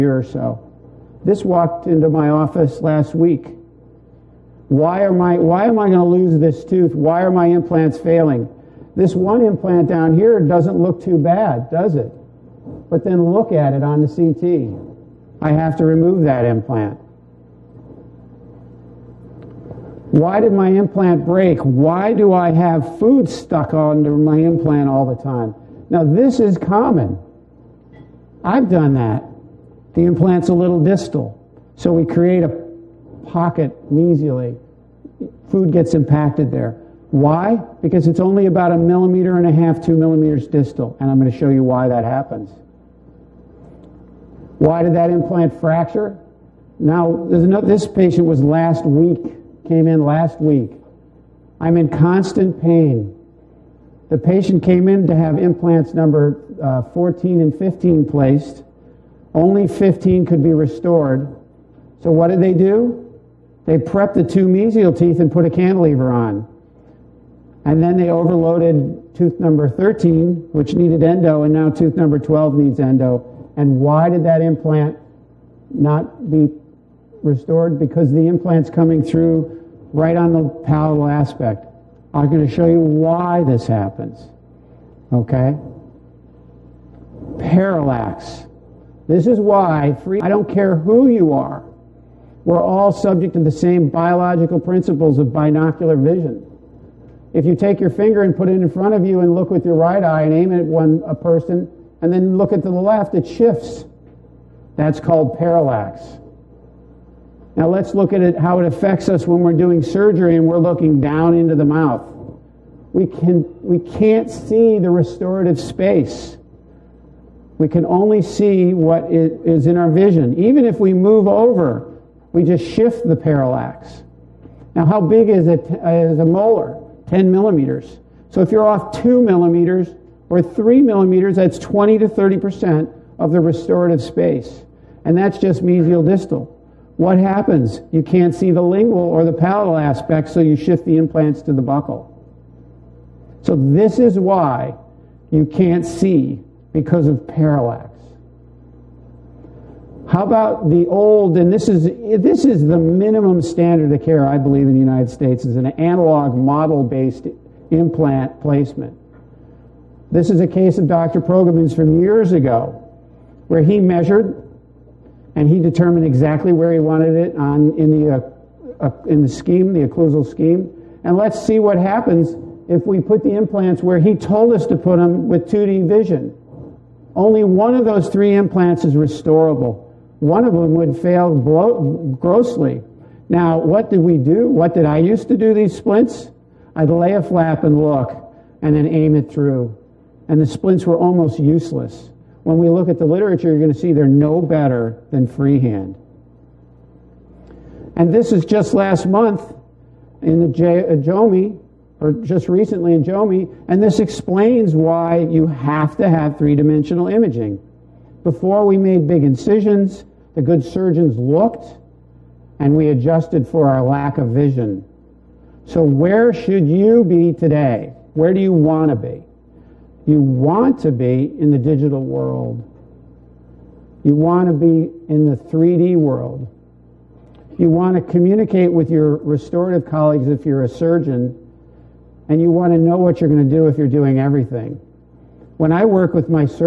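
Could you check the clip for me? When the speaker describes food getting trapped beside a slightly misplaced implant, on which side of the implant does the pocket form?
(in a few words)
mesially.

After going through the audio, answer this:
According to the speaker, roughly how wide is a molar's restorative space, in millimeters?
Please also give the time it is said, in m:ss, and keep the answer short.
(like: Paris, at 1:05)
10 millimeters, at 2:07.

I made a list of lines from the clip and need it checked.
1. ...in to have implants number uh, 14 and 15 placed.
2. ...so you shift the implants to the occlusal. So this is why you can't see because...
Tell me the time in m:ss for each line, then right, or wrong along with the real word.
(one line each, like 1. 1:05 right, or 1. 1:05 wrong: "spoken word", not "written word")
1. 0:54 right
2. 2:20 wrong: "buccal", not "occlusal".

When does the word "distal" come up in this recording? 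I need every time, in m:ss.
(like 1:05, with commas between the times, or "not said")
0:30, 0:40, 2:16.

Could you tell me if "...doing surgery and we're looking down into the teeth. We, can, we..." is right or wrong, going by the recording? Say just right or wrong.
wrong.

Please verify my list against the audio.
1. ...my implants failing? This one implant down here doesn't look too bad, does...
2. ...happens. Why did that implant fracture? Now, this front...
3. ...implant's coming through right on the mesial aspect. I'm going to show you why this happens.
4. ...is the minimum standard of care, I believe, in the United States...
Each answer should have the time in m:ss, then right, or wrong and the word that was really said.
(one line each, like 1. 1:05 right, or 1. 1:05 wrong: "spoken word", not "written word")
1. 0:07 right
2. 0:42 wrong: "patient", not "front"
3. 1:18 wrong: "palatal", not "mesial"
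4. 2:32 right.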